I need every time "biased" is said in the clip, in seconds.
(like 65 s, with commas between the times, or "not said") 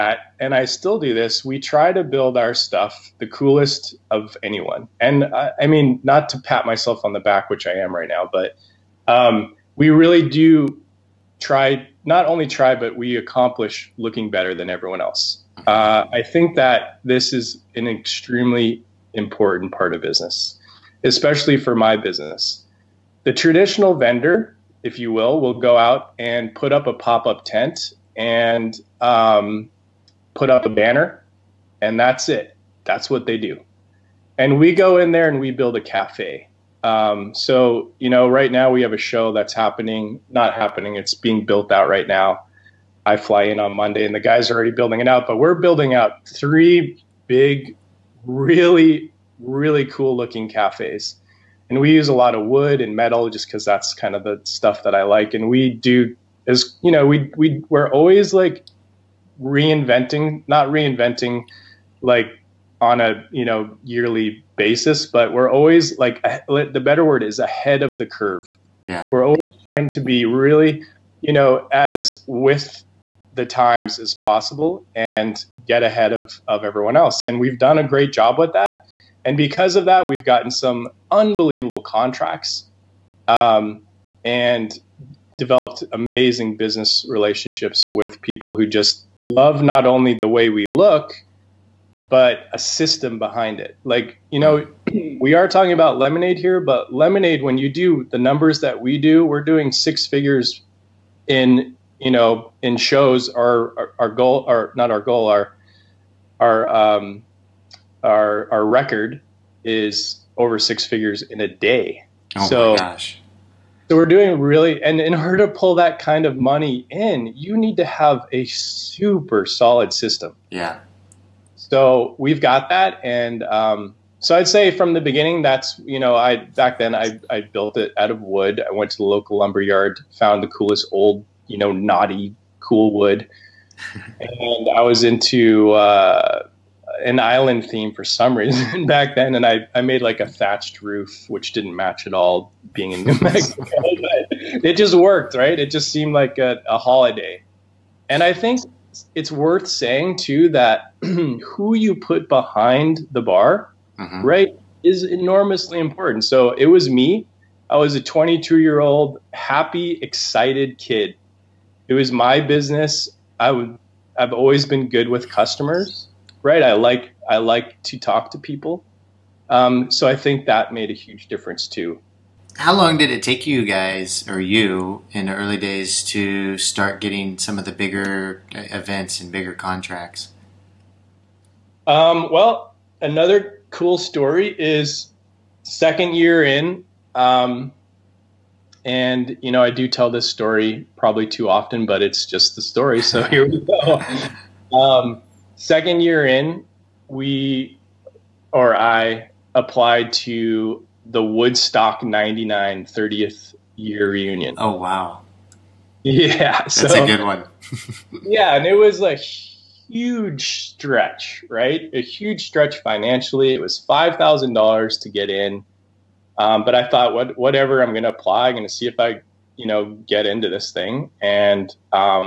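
not said.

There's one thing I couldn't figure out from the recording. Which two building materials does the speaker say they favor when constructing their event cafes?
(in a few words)
wood and metal.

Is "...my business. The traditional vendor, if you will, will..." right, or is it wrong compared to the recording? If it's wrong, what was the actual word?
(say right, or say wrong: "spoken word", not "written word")
right.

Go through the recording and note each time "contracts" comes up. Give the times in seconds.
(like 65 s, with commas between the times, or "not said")
81 s, 179 s.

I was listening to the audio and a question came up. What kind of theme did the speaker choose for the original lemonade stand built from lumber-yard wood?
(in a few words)
island theme.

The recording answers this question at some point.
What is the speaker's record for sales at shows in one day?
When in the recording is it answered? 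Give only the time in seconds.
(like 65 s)
110 s.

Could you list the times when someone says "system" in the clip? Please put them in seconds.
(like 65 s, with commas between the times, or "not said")
92 s, 119 s.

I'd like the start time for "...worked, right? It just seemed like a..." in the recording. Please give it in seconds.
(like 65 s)
144 s.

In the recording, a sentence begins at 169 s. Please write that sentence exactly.
Um, so I think that made a huge difference too.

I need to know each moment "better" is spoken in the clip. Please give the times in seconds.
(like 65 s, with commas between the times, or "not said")
14 s, 66 s.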